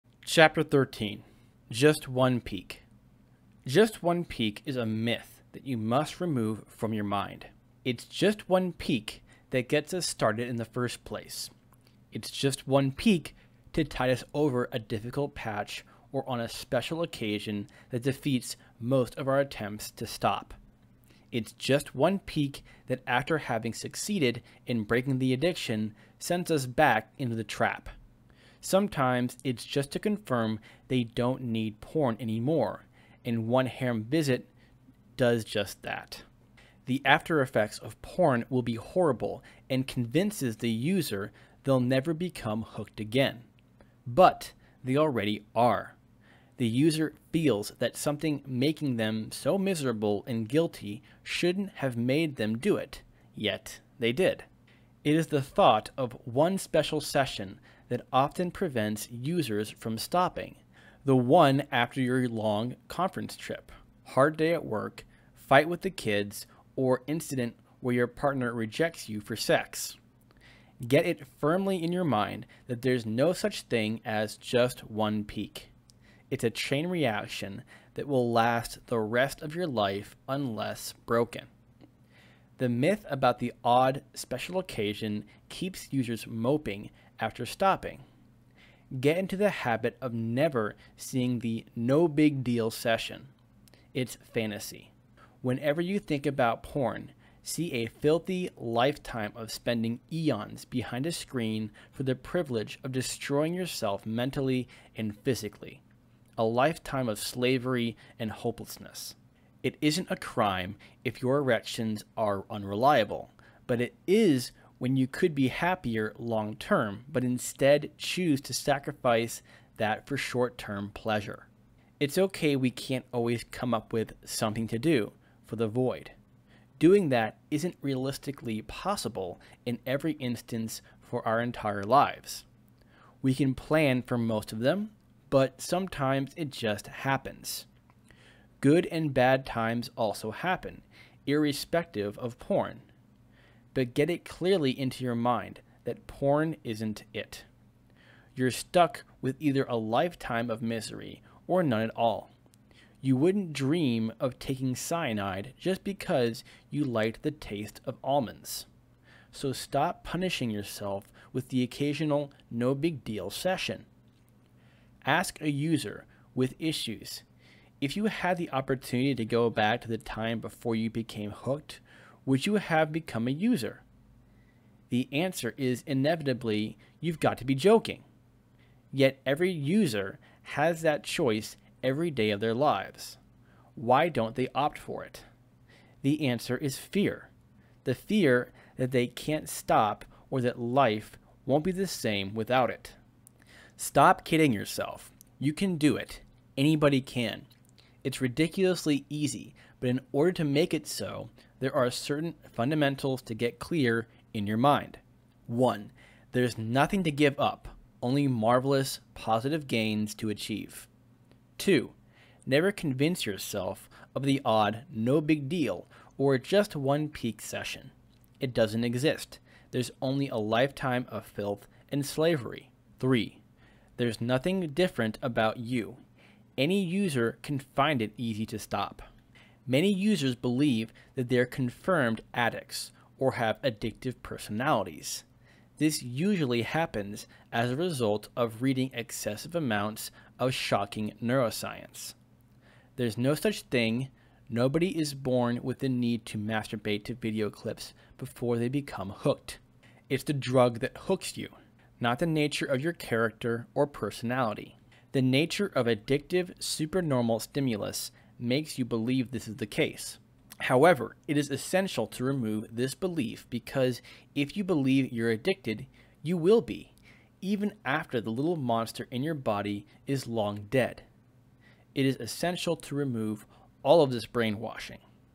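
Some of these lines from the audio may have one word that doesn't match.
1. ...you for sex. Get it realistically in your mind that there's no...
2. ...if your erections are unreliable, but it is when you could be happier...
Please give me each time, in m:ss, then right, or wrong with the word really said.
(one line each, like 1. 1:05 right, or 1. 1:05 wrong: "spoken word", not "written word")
1. 1:09 wrong: "firmly", not "realistically"
2. 1:51 right.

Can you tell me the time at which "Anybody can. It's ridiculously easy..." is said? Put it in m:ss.
3:16.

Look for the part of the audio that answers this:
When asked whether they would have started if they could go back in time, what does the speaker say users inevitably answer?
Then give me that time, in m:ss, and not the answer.
2:56.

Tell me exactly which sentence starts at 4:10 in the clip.
It's the drug that hooks you, not the nature of your character or personality.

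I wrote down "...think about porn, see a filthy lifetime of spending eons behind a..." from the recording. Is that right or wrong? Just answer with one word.
right.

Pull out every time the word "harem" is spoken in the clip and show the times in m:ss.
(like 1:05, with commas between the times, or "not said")
0:33.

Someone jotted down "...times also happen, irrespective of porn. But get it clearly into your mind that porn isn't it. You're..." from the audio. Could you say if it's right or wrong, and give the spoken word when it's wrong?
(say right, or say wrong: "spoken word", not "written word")
right.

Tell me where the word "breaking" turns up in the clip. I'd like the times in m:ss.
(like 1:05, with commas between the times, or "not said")
0:24.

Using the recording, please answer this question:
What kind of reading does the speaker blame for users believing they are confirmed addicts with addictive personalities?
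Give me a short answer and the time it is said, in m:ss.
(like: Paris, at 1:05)
shocking neuroscience, at 4:00.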